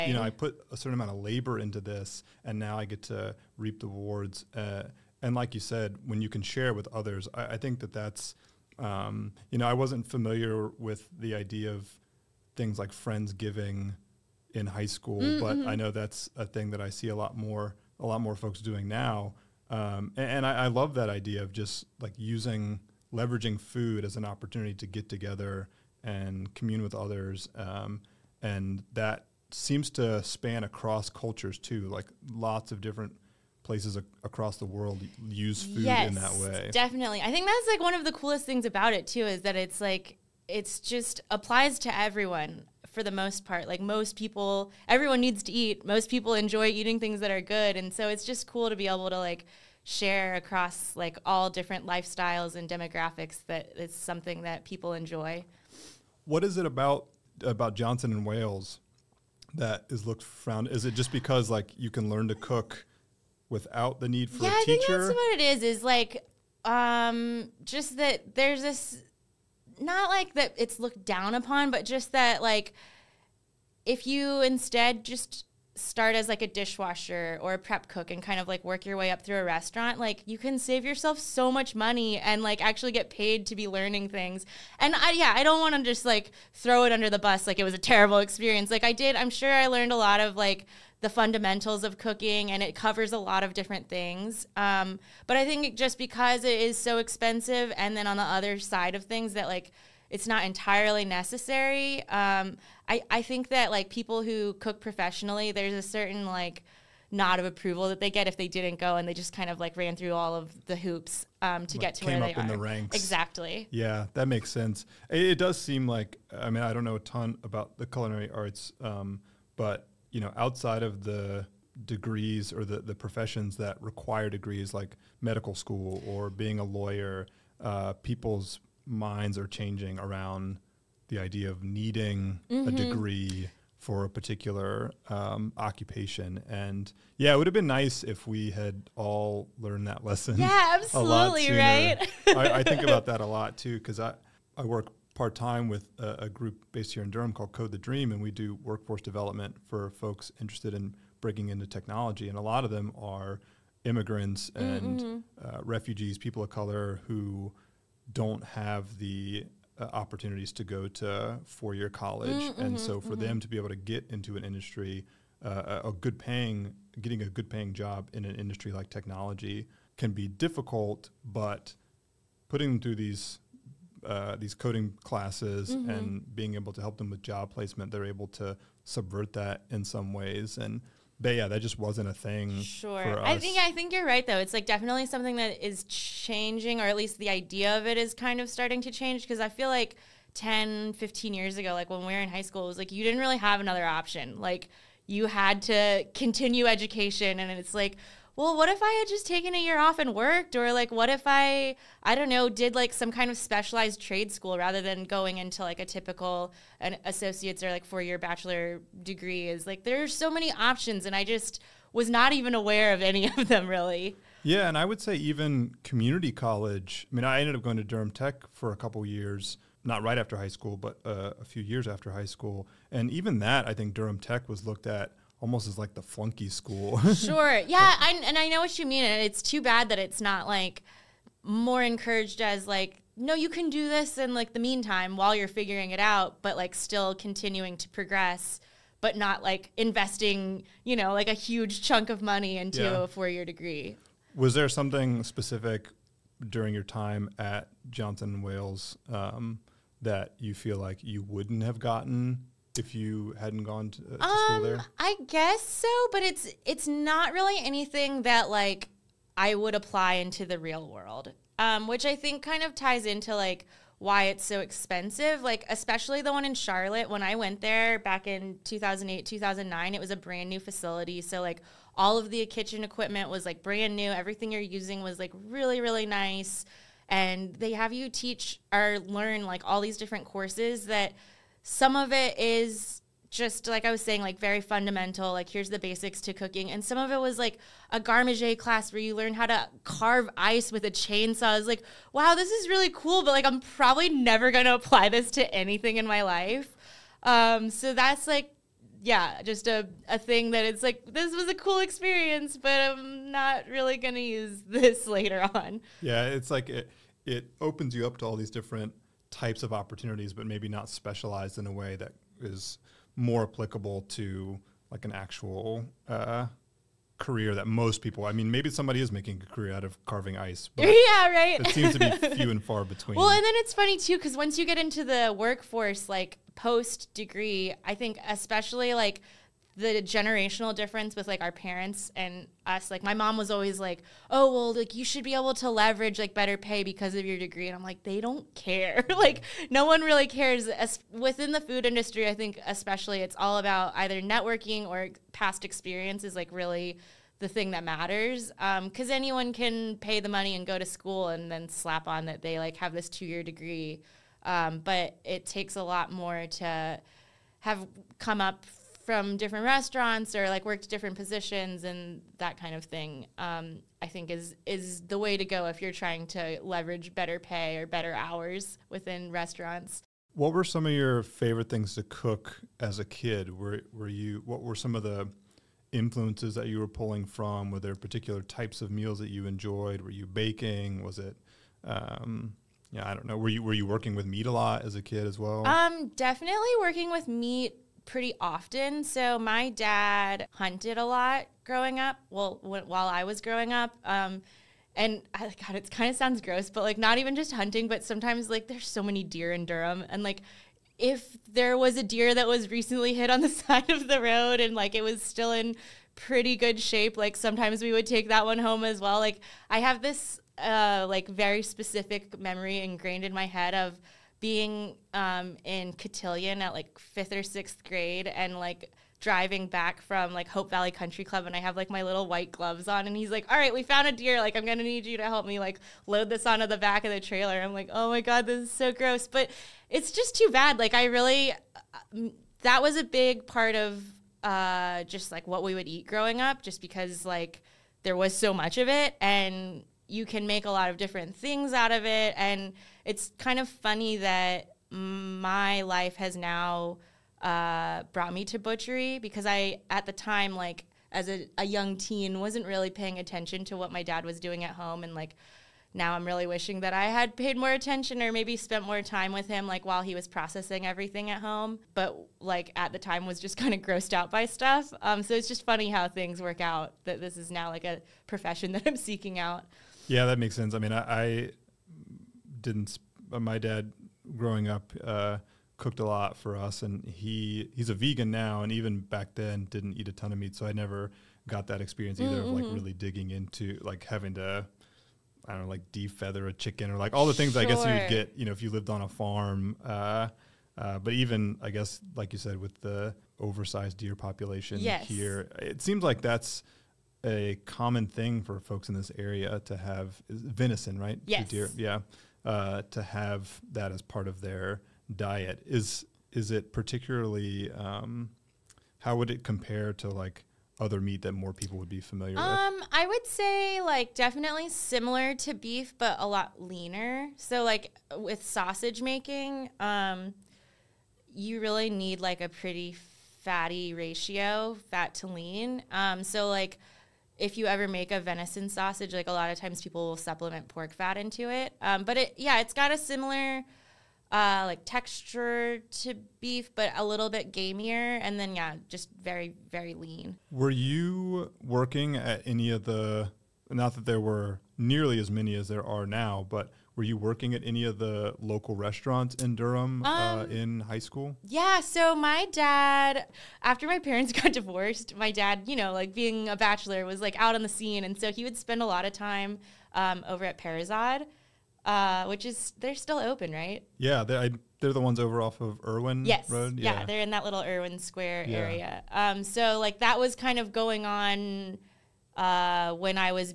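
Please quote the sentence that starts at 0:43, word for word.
Like most people, everyone needs to eat.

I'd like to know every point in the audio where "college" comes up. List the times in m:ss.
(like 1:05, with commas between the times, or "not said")
2:41, 3:36.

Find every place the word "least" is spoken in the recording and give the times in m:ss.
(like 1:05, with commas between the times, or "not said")
3:06.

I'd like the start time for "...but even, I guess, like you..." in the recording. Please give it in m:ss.
8:10.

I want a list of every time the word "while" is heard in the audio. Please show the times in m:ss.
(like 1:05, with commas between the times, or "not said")
3:55, 6:32, 7:39.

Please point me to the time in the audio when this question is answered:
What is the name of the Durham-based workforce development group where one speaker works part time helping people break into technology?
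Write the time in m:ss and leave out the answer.
2:27.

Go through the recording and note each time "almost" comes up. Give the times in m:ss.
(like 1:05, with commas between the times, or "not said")
3:45.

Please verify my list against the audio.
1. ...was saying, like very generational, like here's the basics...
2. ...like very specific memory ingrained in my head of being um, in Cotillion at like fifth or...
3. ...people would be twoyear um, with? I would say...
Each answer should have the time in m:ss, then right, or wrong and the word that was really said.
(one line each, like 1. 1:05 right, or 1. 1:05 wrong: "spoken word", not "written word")
1. 4:43 wrong: "fundamental", not "generational"
2. 6:51 right
3. 8:31 wrong: "familiar", not "twoyear".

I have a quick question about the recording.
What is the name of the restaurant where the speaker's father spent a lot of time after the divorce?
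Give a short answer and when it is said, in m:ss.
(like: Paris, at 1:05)
Parizade, at 9:20.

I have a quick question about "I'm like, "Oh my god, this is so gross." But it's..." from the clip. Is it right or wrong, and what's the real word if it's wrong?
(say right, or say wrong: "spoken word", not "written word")
right.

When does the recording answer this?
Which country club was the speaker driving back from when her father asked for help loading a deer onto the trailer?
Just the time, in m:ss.
7:00.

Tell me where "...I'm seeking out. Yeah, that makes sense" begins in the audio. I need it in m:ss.
7:48.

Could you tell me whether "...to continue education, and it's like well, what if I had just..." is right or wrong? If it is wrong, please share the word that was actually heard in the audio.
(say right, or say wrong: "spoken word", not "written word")
right.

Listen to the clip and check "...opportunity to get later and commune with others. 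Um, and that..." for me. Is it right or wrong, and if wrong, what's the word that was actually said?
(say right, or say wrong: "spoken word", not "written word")
wrong: "together", not "later".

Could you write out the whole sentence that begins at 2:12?
a degree for a particular um, occupation.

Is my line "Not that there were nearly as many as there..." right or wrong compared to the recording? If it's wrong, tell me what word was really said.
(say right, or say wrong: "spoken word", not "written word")
right.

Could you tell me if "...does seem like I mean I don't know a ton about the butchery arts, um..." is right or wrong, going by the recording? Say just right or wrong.
wrong.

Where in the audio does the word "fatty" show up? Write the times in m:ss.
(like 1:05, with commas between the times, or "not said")
8:43.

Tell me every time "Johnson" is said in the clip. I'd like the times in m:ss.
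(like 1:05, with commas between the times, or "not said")
0:57, 4:07.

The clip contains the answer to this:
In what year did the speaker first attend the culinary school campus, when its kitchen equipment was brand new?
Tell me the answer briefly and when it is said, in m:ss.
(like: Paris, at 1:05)
2008, at 4:28.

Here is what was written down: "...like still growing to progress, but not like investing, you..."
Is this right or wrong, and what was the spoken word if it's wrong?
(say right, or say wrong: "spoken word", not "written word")
wrong: "continuing", not "growing".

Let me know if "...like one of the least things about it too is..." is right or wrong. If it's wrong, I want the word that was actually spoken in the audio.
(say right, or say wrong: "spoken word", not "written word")
wrong: "coolest", not "least".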